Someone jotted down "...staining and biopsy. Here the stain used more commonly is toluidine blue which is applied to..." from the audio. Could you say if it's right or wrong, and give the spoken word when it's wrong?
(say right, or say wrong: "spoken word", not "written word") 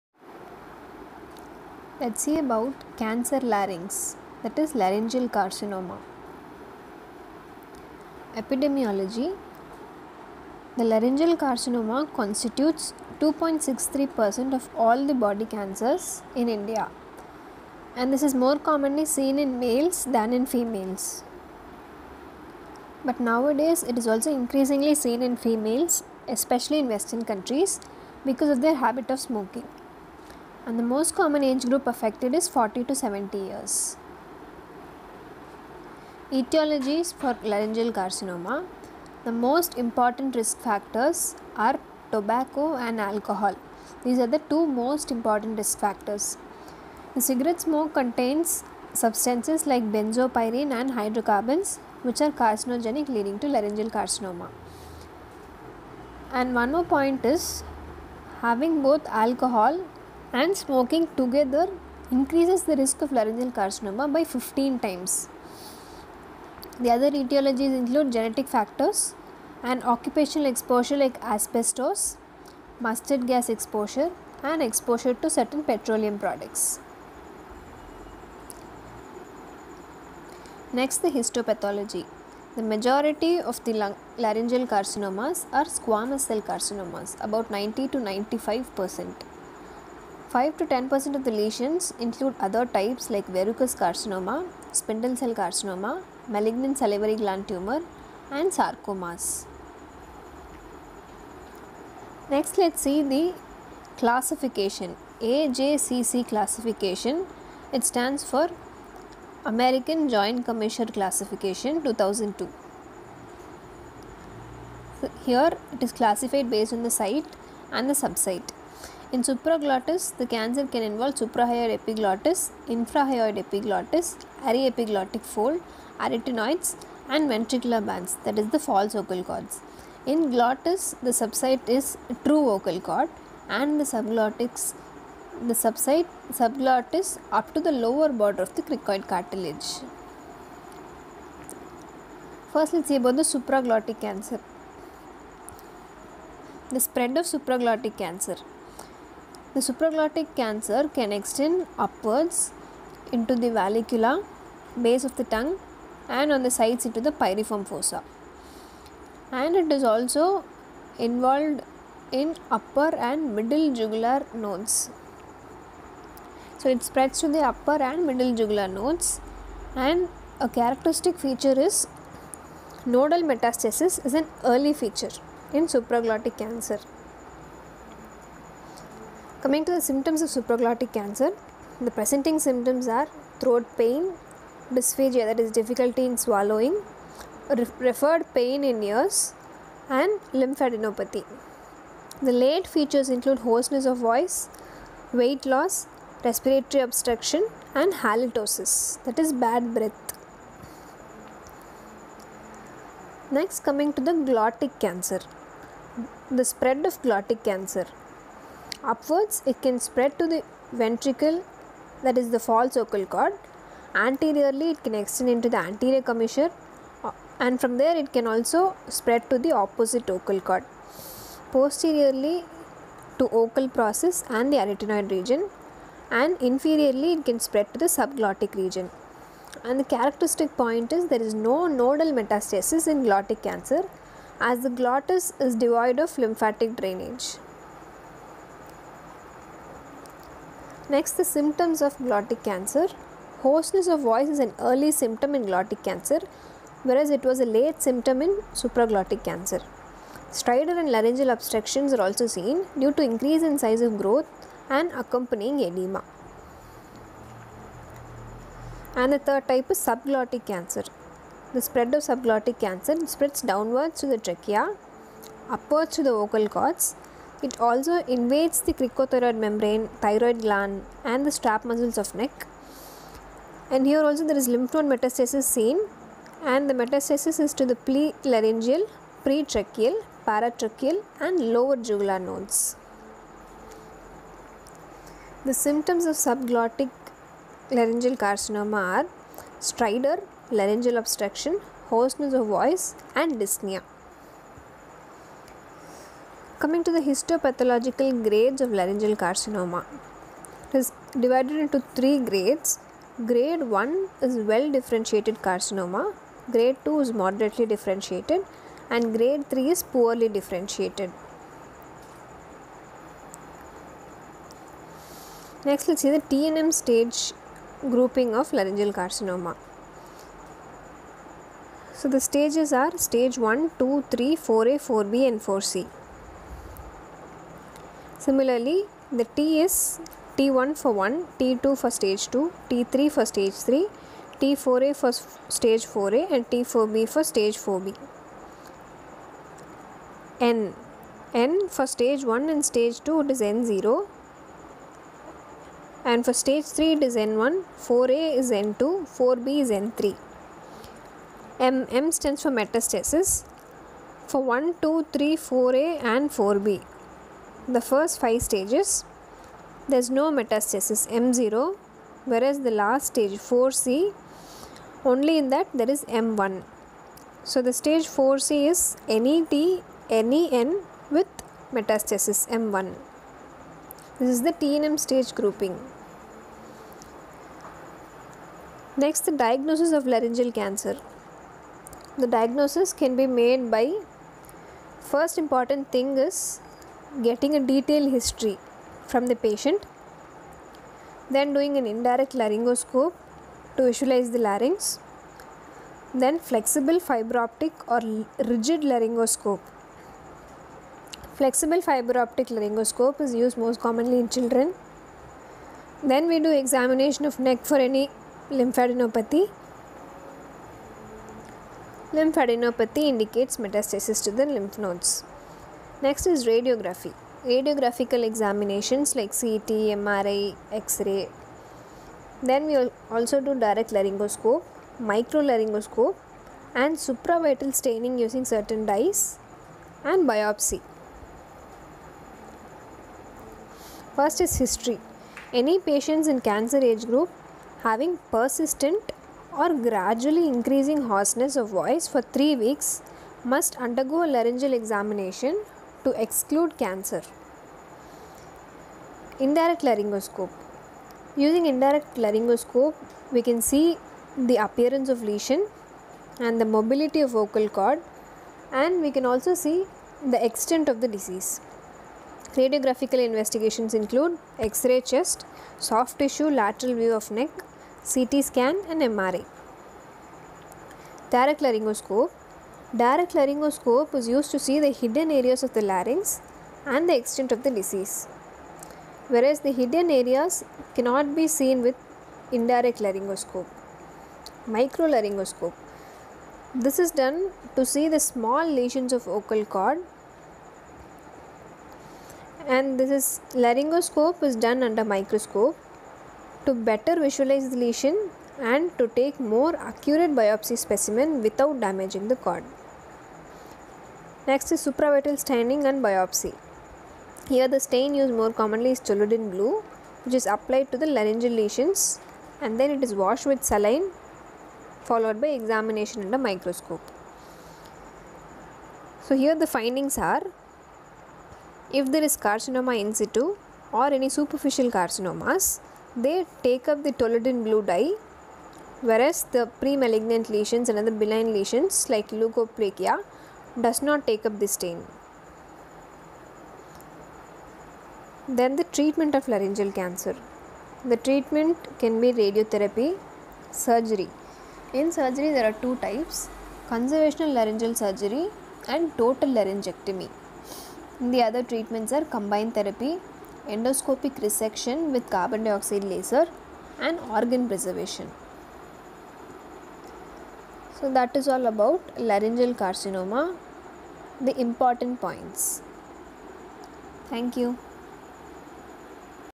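right.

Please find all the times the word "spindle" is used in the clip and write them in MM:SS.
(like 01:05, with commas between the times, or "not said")
01:34.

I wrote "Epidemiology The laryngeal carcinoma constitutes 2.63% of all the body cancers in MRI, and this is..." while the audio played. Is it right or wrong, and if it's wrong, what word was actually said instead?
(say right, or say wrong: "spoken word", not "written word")
wrong: "India", not "MRI".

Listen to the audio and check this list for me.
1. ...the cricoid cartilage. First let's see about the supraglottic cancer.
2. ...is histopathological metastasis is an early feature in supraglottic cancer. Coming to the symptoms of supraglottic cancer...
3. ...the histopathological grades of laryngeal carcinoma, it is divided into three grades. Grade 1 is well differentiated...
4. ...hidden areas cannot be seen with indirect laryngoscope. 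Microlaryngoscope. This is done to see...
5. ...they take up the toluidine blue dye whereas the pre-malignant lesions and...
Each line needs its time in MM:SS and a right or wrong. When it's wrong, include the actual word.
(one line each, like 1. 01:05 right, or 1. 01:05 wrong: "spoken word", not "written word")
1. 02:18 right
2. 02:51 wrong: "nodal", not "histopathological"
3. 04:56 right
4. 07:59 right
5. 08:46 right.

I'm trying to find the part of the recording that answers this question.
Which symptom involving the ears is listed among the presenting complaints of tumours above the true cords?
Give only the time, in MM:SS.
03:07.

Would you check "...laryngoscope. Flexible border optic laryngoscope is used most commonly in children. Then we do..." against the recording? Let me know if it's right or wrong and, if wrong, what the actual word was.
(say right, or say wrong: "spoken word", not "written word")
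wrong: "fiber", not "border".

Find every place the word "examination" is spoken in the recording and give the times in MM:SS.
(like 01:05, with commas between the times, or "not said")
06:46, 06:58, 07:24, 08:35.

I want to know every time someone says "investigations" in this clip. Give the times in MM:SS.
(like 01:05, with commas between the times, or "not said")
07:43.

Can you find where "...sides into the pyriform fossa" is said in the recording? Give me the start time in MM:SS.
02:36.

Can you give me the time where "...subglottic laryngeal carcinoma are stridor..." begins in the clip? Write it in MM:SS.
04:46.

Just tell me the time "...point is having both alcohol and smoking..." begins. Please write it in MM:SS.
00:56.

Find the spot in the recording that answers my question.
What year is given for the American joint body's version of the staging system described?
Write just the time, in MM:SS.
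01:51.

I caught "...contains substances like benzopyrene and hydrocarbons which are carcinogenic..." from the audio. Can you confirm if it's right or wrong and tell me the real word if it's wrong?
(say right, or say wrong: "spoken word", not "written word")
right.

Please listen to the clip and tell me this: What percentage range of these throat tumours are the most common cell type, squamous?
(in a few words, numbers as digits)
90 to 95 percent.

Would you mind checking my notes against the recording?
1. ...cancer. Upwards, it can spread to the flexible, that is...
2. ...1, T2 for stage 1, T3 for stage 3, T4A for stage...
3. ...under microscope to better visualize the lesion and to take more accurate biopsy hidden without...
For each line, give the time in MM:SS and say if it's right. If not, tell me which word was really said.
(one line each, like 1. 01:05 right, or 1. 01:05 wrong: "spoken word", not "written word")
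1. 03:27 wrong: "ventricle", not "flexible"
2. 05:30 wrong: "2", not "1"
3. 08:14 wrong: "specimen", not "hidden".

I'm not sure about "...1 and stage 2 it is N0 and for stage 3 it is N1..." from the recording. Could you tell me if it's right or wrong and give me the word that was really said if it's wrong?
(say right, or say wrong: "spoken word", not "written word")
right.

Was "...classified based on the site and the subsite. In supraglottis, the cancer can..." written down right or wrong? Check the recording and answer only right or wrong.
right.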